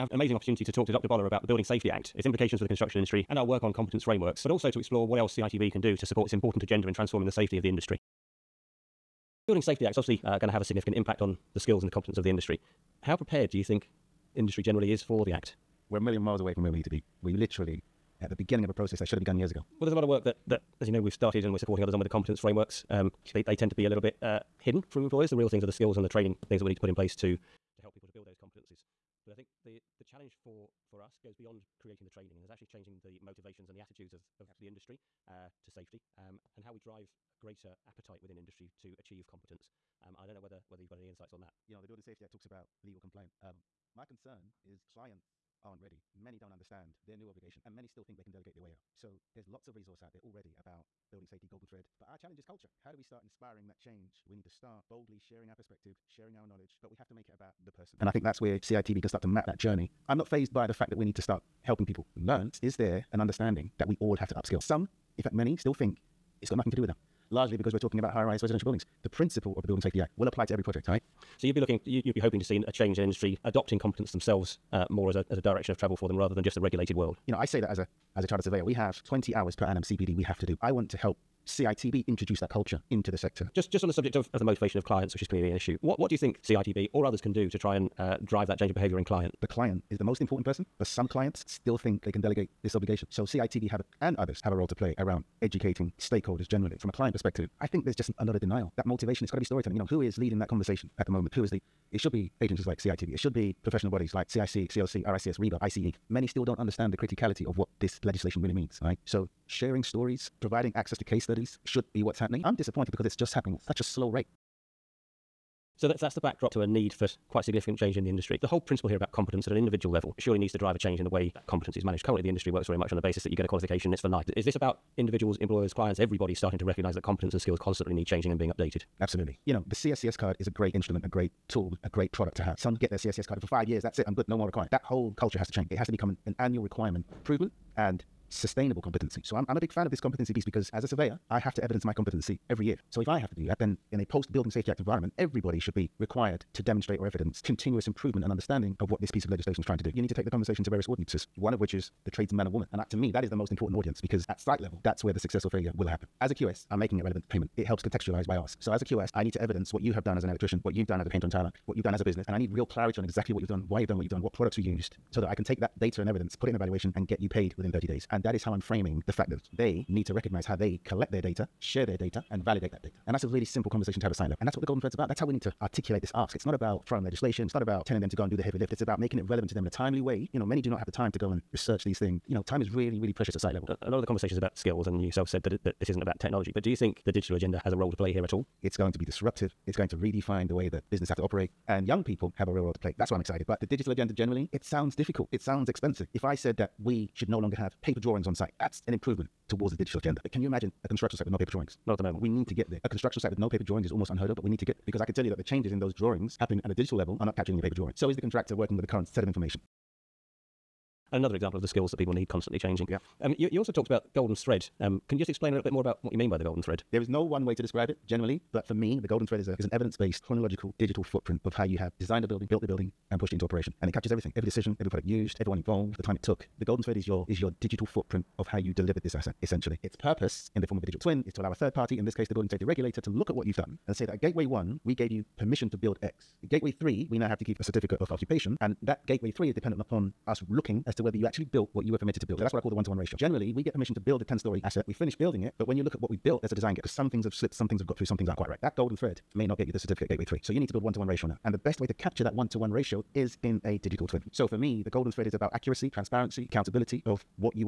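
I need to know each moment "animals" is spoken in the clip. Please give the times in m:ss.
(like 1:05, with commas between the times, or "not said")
not said.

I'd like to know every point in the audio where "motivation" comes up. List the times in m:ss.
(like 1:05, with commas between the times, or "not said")
0:33, 1:24, 1:38.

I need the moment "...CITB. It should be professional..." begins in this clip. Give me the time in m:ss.
1:42.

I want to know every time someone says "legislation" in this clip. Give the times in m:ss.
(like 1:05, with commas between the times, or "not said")
1:48, 2:29, 2:57.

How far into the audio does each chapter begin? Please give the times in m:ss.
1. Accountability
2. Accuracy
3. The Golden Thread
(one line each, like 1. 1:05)
1. 0:08
2. 1:54
3. 3:29.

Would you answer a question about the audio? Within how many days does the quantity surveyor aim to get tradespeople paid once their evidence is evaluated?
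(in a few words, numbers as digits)
30 days.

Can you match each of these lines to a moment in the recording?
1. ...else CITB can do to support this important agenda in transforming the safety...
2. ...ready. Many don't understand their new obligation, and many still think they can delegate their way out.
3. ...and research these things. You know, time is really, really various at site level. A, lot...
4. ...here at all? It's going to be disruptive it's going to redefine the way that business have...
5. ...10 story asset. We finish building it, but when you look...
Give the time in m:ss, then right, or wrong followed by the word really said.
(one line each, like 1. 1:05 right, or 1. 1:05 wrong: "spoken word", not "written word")
1. 0:05 right
2. 0:45 right
3. 3:01 wrong: "precious", not "various"
4. 3:08 right
5. 4:04 right.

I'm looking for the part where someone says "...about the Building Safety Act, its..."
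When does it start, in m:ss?
0:01.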